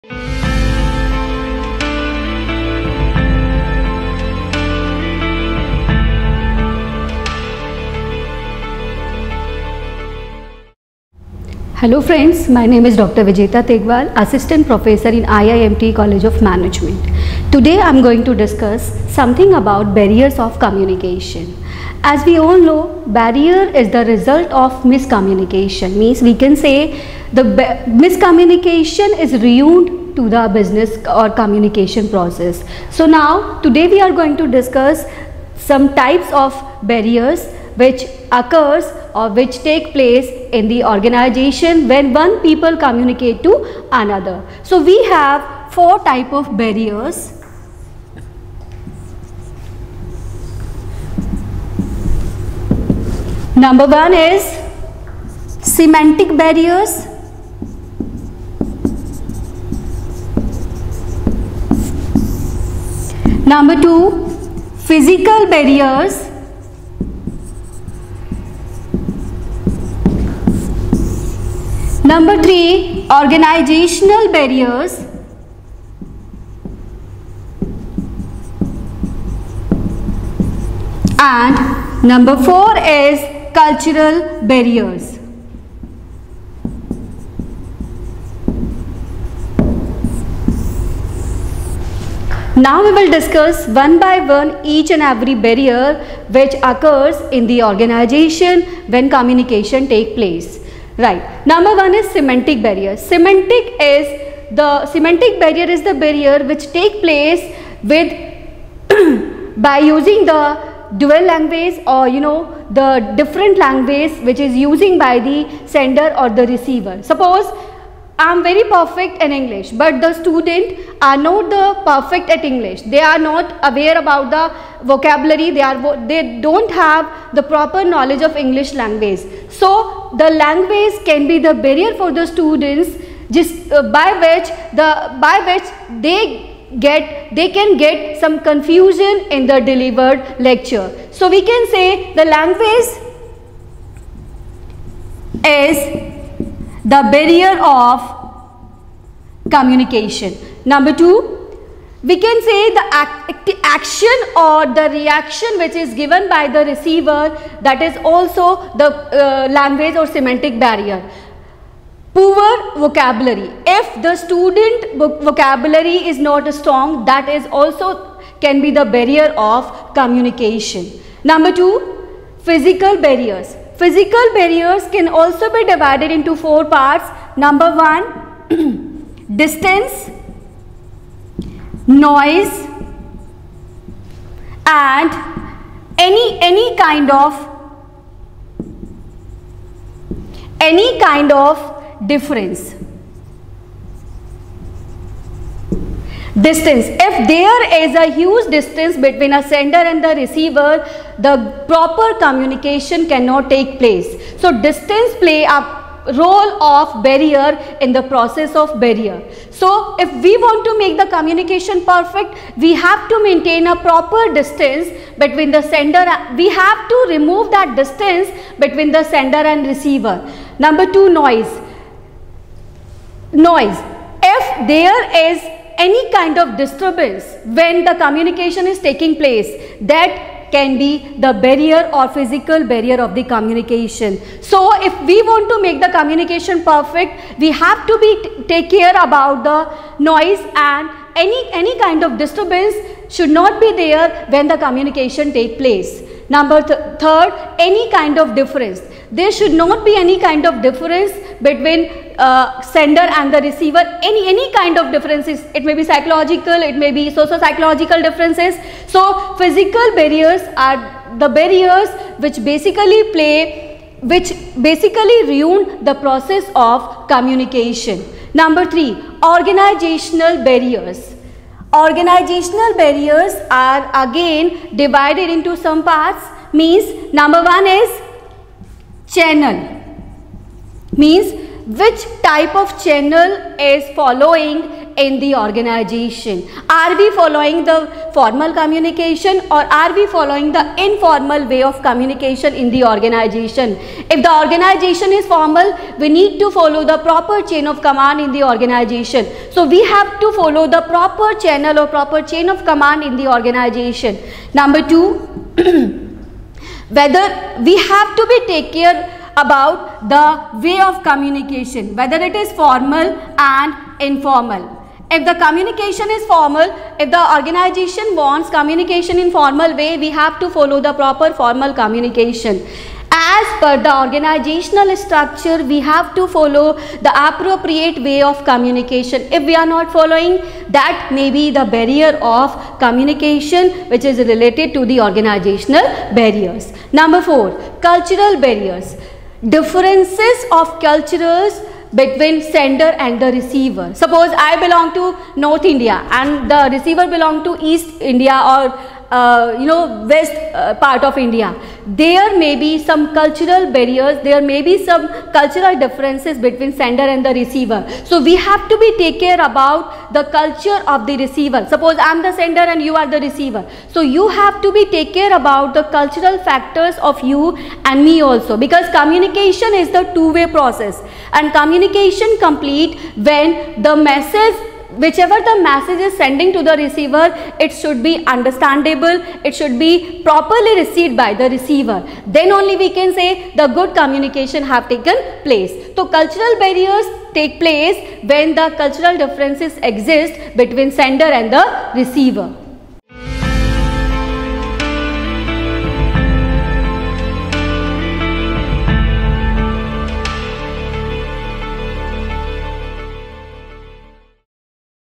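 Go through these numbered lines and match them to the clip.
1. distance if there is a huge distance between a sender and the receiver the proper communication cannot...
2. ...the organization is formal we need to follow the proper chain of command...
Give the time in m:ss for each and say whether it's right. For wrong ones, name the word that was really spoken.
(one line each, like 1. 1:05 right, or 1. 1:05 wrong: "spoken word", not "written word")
1. 3:16 right
2. 4:54 right.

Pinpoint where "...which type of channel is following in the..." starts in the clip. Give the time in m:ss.
4:41.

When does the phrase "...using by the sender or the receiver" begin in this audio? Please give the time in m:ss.
1:54.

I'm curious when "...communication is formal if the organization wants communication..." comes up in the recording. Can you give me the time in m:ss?
5:15.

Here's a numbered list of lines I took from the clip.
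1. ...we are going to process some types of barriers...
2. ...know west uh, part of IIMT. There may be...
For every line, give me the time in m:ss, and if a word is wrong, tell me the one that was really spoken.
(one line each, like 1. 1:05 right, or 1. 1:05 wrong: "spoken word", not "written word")
1. 0:33 wrong: "discuss", not "process"
2. 5:49 wrong: "India", not "IIMT".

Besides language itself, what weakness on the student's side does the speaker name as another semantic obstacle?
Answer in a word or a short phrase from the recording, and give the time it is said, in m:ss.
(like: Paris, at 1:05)
Poor vocabulary, at 2:42.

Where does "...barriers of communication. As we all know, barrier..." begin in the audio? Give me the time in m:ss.
0:19.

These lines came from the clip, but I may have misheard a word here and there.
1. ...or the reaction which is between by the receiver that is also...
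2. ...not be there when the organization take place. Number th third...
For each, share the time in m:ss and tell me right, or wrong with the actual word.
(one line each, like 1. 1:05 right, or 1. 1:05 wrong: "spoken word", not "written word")
1. 2:34 wrong: "given", not "between"
2. 4:03 wrong: "communication", not "organization".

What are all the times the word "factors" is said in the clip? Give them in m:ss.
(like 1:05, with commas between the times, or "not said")
6:06.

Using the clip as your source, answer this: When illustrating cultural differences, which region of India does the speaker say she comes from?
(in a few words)
North India.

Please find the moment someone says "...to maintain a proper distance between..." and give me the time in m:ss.
3:33.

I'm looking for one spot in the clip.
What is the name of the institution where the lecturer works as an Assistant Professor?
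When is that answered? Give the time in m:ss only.
0:15.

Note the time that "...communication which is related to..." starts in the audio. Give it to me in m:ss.
5:32.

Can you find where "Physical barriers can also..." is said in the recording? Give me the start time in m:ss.
2:53.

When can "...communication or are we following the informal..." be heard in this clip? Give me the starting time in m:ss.
4:48.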